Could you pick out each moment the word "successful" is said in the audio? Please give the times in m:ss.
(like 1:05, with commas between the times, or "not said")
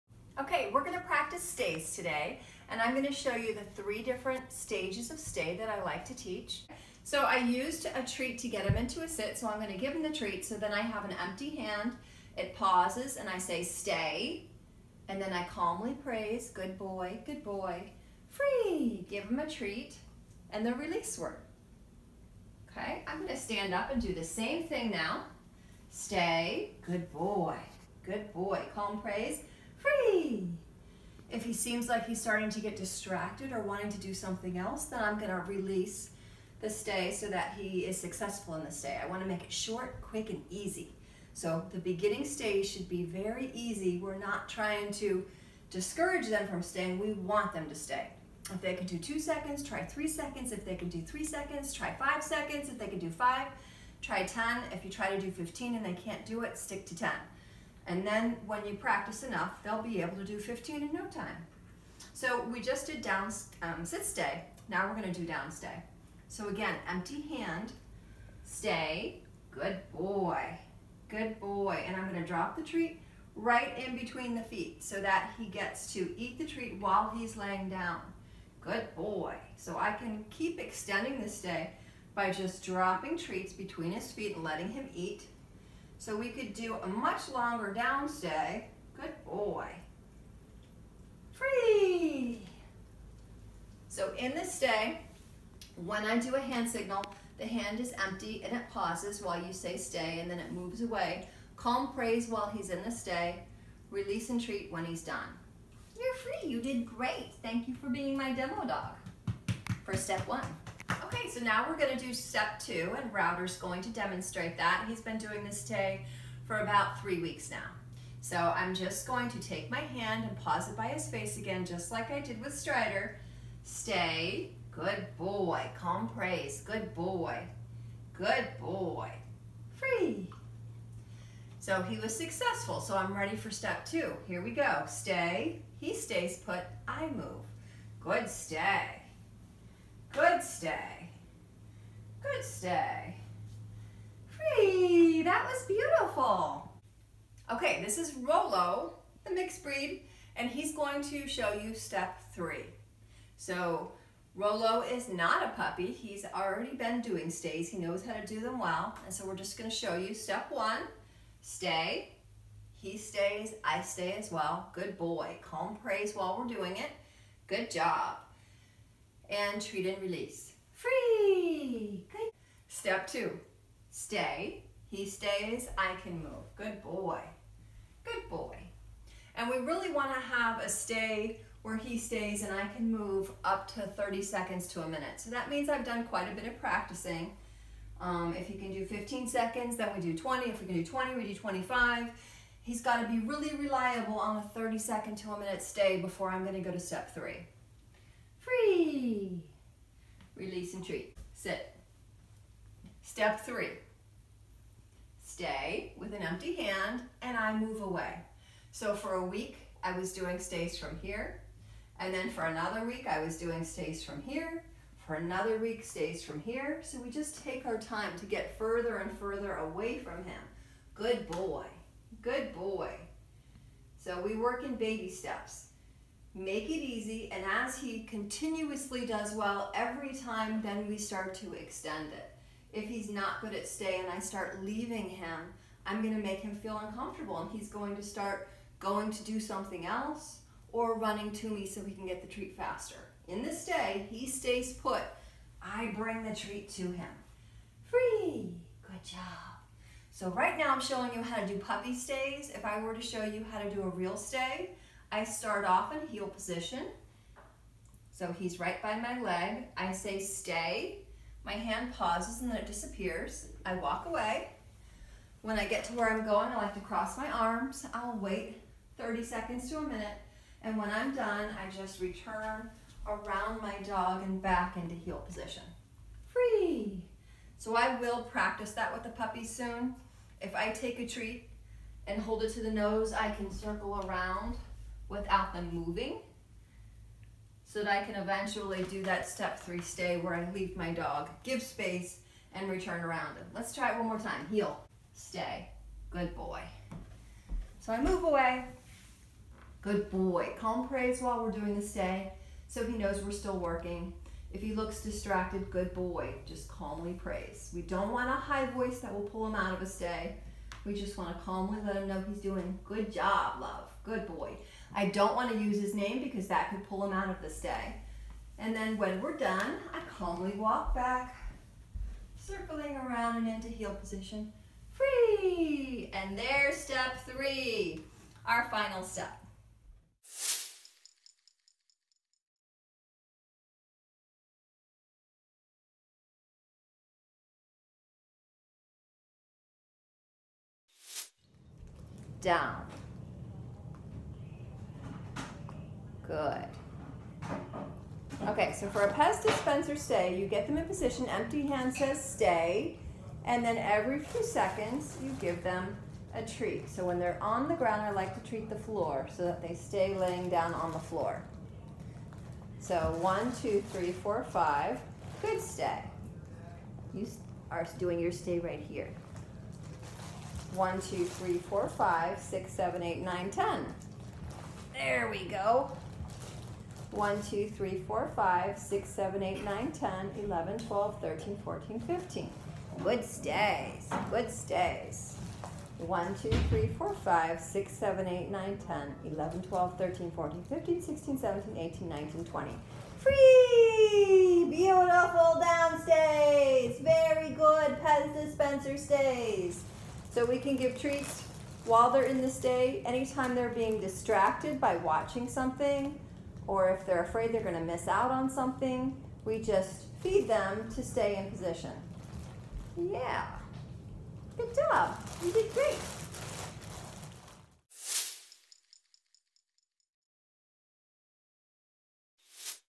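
0:37, 2:12.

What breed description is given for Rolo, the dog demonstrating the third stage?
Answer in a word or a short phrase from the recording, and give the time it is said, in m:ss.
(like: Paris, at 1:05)
mixed breed, at 2:29.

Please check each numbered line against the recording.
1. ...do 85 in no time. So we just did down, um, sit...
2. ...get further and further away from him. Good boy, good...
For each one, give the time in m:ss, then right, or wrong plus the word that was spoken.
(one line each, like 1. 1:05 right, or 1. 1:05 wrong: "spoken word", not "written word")
1. 1:00 wrong: "15", not "85"
2. 3:38 right.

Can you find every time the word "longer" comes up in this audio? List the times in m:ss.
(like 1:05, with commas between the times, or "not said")
1:27.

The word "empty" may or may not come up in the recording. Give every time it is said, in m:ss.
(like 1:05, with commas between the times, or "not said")
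0:11, 1:06, 1:38, 3:26, 5:51.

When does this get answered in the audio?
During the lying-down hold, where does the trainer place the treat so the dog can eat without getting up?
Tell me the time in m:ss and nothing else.
1:13.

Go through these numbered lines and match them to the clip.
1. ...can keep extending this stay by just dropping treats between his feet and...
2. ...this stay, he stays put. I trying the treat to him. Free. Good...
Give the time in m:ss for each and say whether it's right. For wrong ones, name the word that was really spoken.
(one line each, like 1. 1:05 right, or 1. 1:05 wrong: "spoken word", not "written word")
1. 1:19 right
2. 4:03 wrong: "bring", not "trying".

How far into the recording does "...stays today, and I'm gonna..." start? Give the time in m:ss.
0:01.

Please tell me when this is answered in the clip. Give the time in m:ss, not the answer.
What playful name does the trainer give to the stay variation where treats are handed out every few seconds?
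5:49.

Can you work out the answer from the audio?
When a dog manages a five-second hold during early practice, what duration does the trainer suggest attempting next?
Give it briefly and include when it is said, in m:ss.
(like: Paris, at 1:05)
10 seconds, at 0:52.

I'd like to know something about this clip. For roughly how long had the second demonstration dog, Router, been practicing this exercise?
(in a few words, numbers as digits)
3 weeks.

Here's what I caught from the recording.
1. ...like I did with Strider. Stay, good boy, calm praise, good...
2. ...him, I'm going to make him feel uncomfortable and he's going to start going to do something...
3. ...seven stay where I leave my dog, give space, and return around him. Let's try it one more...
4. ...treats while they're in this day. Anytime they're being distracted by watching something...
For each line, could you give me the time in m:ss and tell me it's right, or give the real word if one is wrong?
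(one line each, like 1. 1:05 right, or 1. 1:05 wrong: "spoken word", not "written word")
1. 2:01 right
2. 3:55 right
3. 4:49 wrong: "three", not "seven"
4. 6:40 right.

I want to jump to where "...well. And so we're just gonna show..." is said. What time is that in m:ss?
2:38.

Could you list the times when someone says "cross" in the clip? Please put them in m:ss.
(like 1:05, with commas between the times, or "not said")
4:26.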